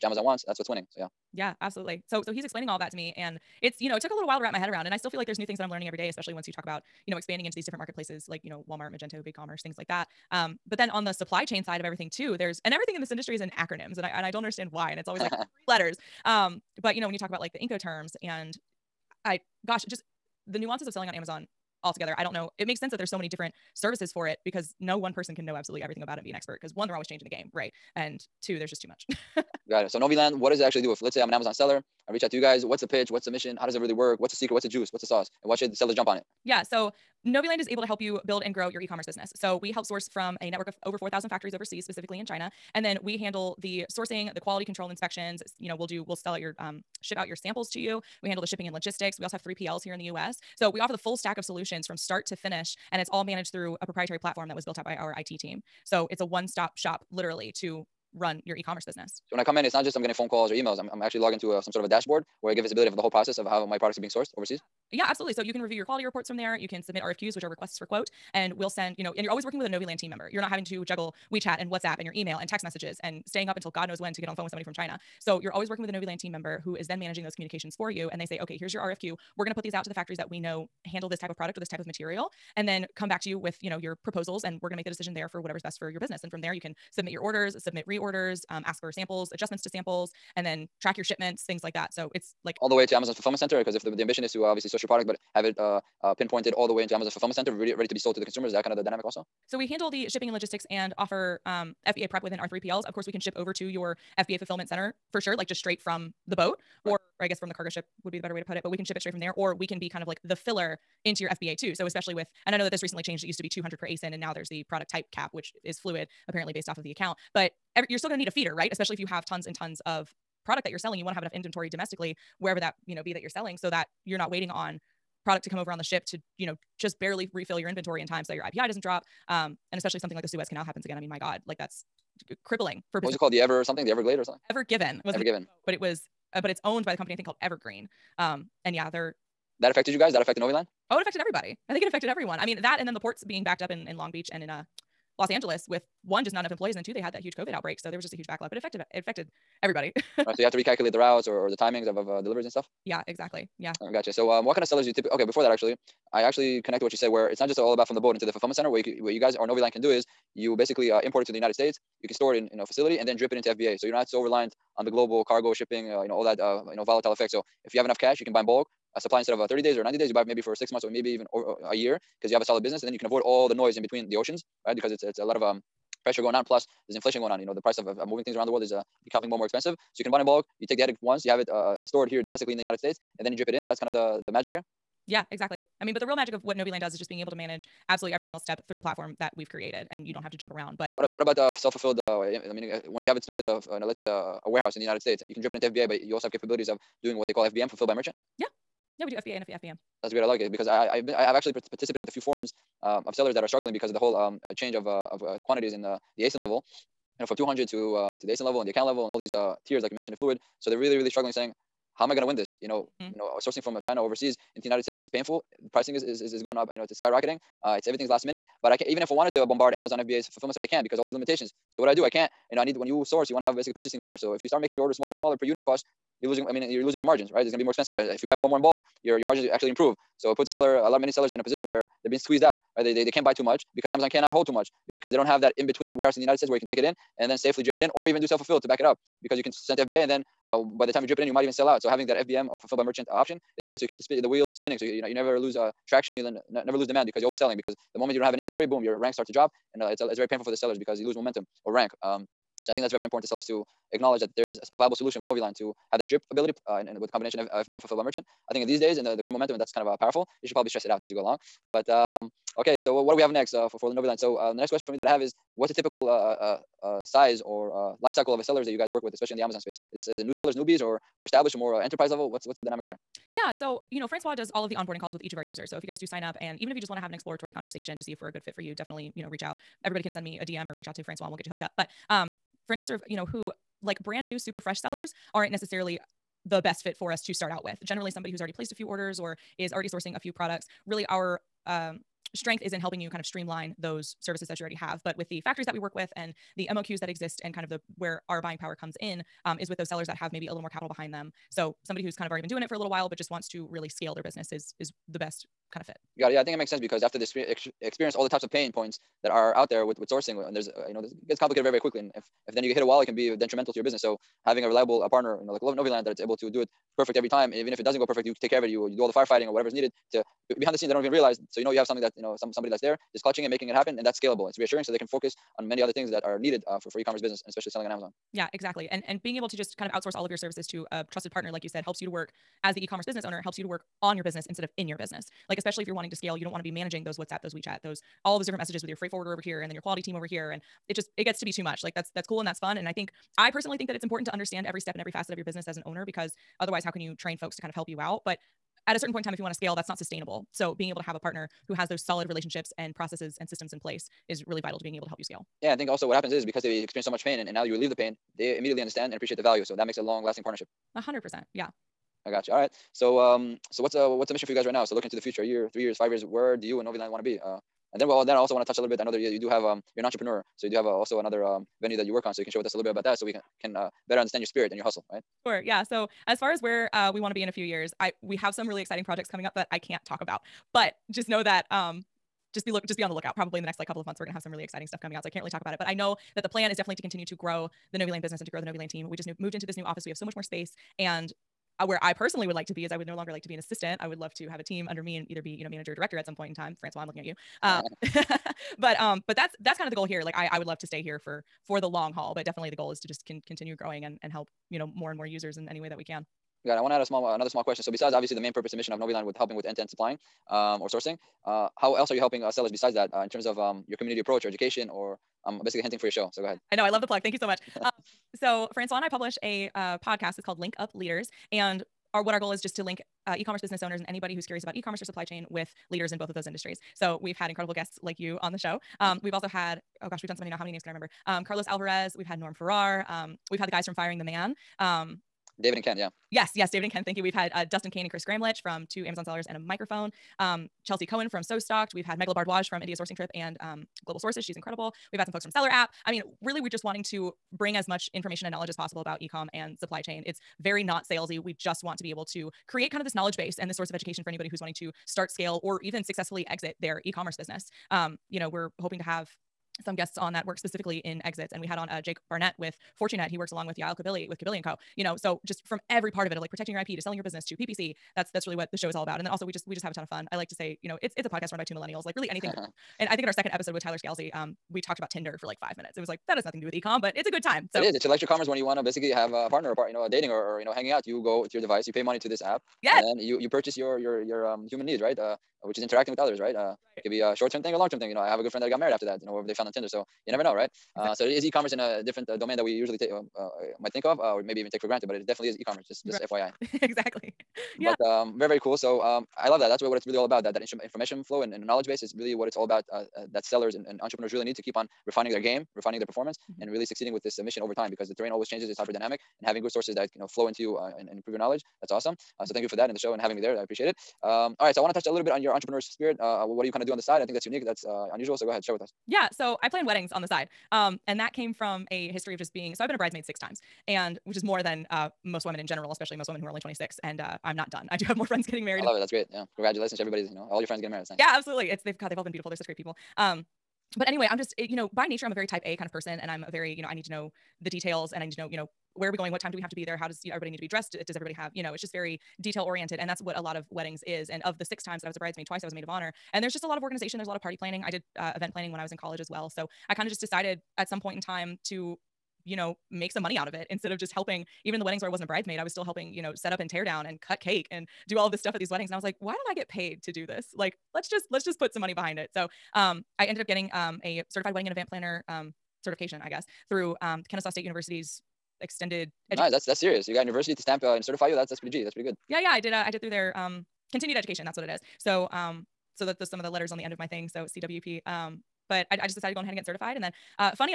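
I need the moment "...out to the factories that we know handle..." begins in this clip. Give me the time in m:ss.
1:19.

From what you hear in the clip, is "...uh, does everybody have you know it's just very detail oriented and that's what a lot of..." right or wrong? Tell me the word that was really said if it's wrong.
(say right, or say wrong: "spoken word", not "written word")
right.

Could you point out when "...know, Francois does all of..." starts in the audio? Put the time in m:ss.
4:33.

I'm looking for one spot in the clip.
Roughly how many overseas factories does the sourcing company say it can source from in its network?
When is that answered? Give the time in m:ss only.
0:40.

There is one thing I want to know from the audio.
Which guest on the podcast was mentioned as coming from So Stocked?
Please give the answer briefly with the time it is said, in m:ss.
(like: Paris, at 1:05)
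Chelsea Cohen, at 7:20.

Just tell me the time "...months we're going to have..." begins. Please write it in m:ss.
6:24.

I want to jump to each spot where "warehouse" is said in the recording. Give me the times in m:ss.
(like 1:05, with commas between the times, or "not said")
3:14, 3:55.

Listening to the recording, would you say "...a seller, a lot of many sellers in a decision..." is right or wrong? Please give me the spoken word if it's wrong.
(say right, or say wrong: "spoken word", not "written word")
wrong: "position", not "decision".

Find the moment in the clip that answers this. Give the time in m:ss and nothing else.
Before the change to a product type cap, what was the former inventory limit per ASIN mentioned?
1:53.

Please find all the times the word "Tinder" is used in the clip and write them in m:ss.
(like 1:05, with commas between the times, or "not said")
7:55, 8:09.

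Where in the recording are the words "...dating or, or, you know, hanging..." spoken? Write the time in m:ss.
8:00.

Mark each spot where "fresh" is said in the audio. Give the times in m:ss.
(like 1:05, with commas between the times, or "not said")
4:44.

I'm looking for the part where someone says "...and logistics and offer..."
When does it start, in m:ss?
1:40.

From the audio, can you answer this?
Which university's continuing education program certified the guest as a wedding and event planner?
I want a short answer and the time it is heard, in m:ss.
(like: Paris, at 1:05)
Kennesaw State University, at 9:27.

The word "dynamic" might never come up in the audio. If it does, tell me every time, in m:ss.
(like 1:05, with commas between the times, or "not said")
1:38, 4:32, 8:28.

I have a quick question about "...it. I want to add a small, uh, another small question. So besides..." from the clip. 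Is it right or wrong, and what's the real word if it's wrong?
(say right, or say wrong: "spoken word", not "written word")
right.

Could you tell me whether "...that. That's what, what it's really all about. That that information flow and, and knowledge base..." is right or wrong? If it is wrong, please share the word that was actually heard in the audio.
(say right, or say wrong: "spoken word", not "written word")
right.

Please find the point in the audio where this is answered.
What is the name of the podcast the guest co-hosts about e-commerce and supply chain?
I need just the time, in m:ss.
7:00.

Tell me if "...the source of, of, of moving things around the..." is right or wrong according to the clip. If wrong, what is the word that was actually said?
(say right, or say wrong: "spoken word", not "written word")
wrong: "price", not "source".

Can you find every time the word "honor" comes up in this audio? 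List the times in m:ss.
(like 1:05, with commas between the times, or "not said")
9:05.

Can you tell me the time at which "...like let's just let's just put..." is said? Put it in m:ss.
9:20.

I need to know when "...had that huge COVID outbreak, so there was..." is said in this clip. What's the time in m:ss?
2:27.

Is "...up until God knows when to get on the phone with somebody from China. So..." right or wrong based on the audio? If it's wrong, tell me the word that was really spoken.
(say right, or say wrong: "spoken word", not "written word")
right.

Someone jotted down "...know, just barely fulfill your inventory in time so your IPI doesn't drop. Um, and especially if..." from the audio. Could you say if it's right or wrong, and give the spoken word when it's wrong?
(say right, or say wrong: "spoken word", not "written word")
wrong: "refill", not "fulfill".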